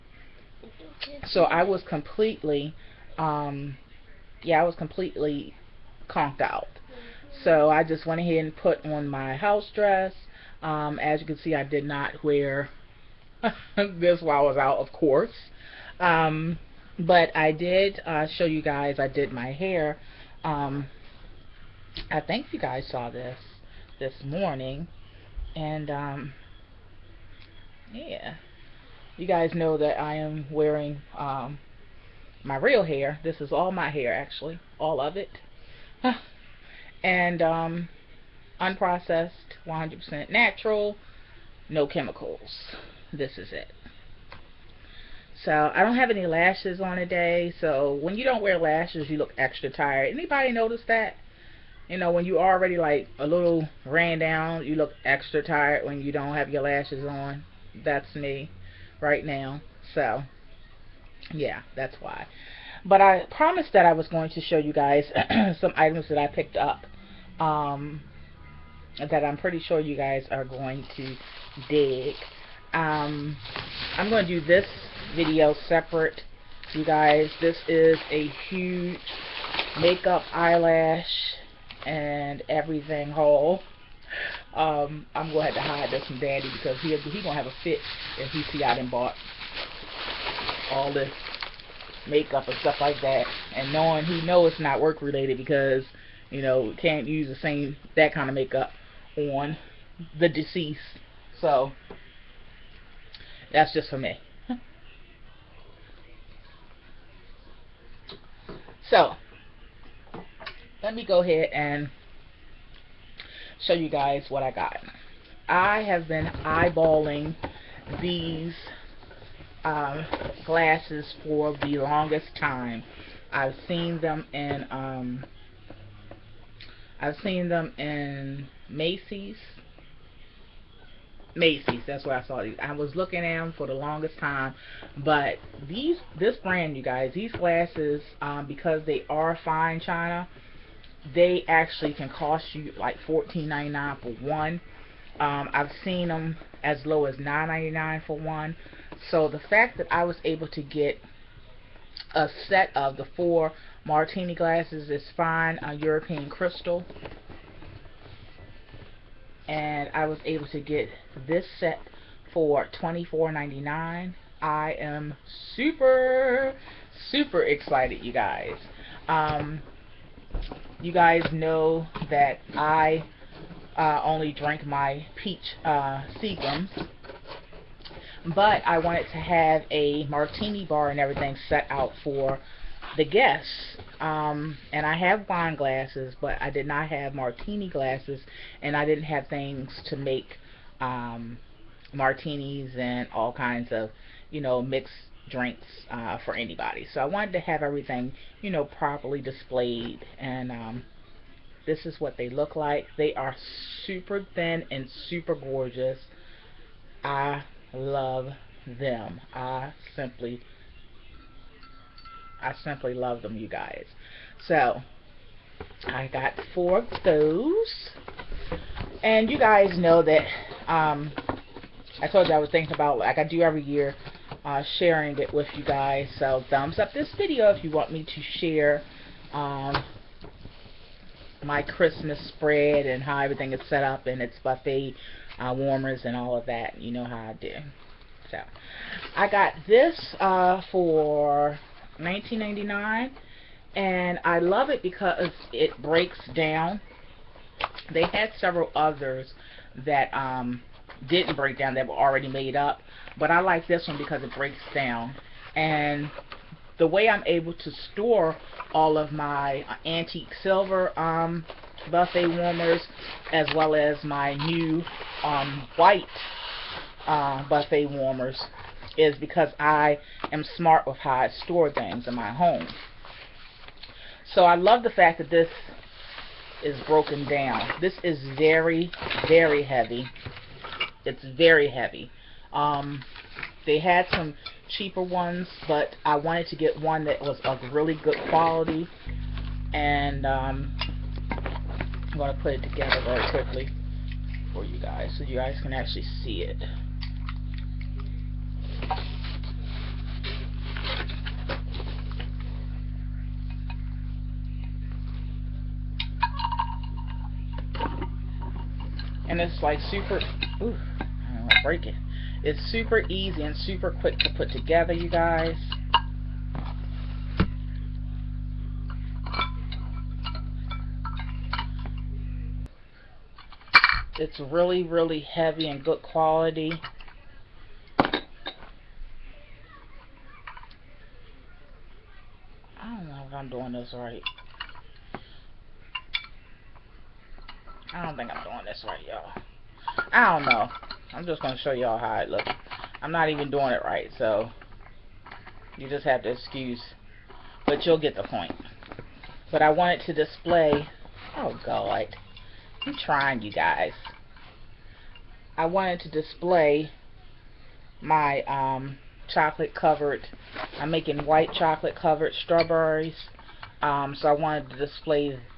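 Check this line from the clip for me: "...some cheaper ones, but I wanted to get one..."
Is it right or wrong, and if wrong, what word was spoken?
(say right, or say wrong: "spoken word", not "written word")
right.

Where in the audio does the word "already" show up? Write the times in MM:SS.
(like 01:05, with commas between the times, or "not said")
00:52, 04:11.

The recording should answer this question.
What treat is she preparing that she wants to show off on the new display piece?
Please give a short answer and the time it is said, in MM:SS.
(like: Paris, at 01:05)
white chocolate covered strawberries, at 06:01.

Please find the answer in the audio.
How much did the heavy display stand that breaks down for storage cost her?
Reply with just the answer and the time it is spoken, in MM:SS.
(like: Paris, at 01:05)
$19.99, at 04:01.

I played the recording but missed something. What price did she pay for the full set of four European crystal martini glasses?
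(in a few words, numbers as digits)
$24.99.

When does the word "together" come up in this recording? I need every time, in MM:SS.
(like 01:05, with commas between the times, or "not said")
04:52, 05:14.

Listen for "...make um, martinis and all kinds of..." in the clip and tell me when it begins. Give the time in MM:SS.
03:09.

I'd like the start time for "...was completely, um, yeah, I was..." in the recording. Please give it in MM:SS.
00:01.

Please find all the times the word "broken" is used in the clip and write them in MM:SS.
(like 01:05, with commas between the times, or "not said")
04:36.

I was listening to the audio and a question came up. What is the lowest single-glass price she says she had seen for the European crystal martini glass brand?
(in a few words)
$9.99.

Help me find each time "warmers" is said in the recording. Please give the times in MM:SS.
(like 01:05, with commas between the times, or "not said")
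03:55, 04:22, 04:27.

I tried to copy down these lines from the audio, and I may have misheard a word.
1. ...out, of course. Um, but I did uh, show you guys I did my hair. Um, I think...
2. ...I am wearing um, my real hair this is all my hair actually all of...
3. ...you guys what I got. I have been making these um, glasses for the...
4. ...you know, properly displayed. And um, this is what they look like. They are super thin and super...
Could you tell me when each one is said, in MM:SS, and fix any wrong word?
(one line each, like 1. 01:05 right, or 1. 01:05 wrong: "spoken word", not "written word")
1. 00:14 right
2. 00:29 right
3. 01:53 wrong: "eyeballing", not "making"
4. 03:18 right.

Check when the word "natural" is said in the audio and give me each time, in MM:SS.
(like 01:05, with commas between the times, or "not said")
00:40.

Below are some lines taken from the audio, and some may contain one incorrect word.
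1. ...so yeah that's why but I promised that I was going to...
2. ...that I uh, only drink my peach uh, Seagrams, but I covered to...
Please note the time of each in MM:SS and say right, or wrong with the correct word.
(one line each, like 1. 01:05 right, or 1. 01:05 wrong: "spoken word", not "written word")
1. 00:59 right
2. 02:52 wrong: "wanted", not "covered".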